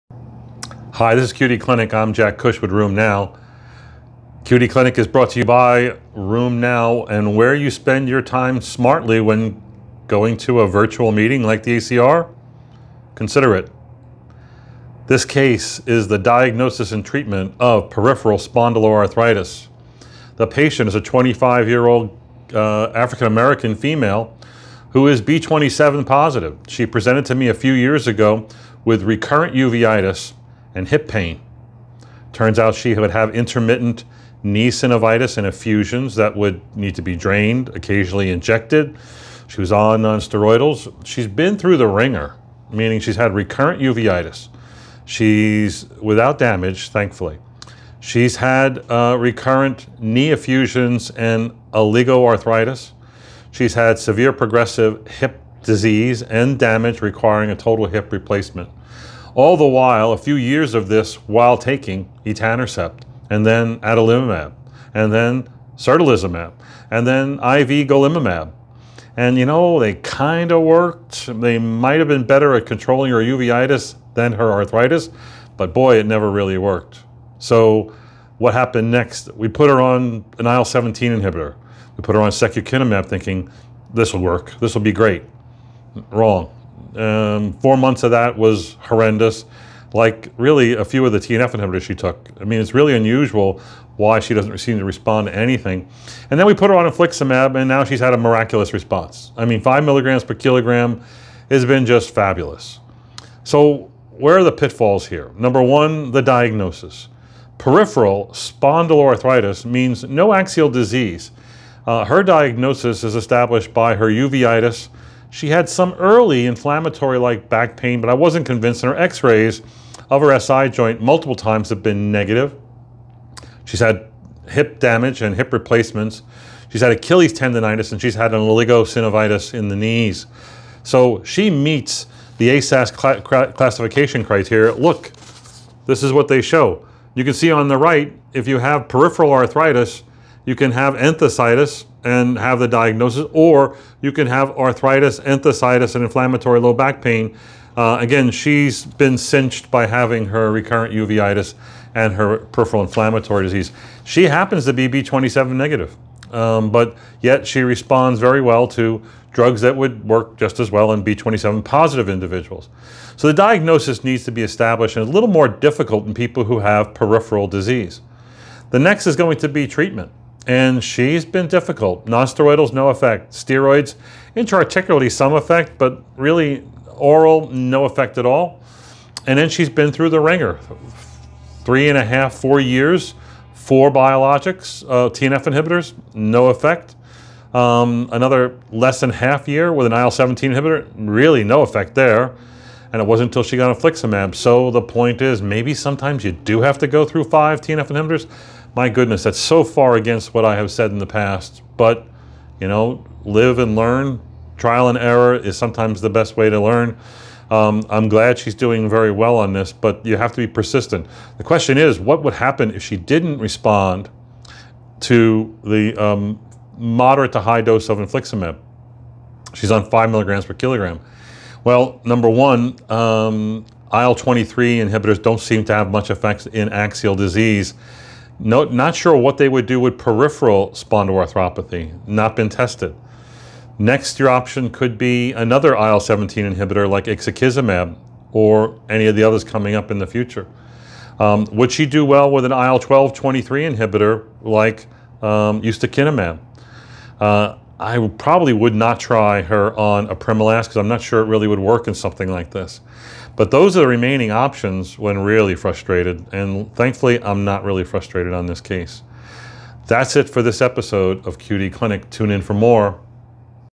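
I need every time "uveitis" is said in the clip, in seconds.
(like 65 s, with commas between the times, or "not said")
29 s, 43 s, 73 s, 114 s, 150 s.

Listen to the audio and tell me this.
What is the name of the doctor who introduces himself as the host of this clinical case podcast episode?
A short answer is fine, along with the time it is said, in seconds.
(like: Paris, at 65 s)
Jack Cush, at 2 s.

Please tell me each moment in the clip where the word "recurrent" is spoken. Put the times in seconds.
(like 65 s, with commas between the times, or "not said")
29 s, 43 s, 49 s, 150 s.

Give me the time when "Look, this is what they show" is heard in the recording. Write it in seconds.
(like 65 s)
134 s.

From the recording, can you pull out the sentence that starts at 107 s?
Peripheral spondyloarthritis means no axial disease.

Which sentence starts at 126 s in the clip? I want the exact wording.
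She's had Achilles tendonitis, and she's had an oligosynovitis in the knees.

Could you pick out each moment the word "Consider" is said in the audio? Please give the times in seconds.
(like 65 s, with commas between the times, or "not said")
13 s.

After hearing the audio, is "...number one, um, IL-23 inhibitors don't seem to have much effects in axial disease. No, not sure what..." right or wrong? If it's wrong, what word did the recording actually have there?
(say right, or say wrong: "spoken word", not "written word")
right.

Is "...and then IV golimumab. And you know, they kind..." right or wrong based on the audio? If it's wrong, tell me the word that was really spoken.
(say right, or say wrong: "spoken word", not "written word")
right.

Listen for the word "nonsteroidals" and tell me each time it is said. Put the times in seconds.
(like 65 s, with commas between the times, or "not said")
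40 s, 172 s.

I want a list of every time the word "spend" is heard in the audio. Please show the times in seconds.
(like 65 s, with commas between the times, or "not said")
7 s.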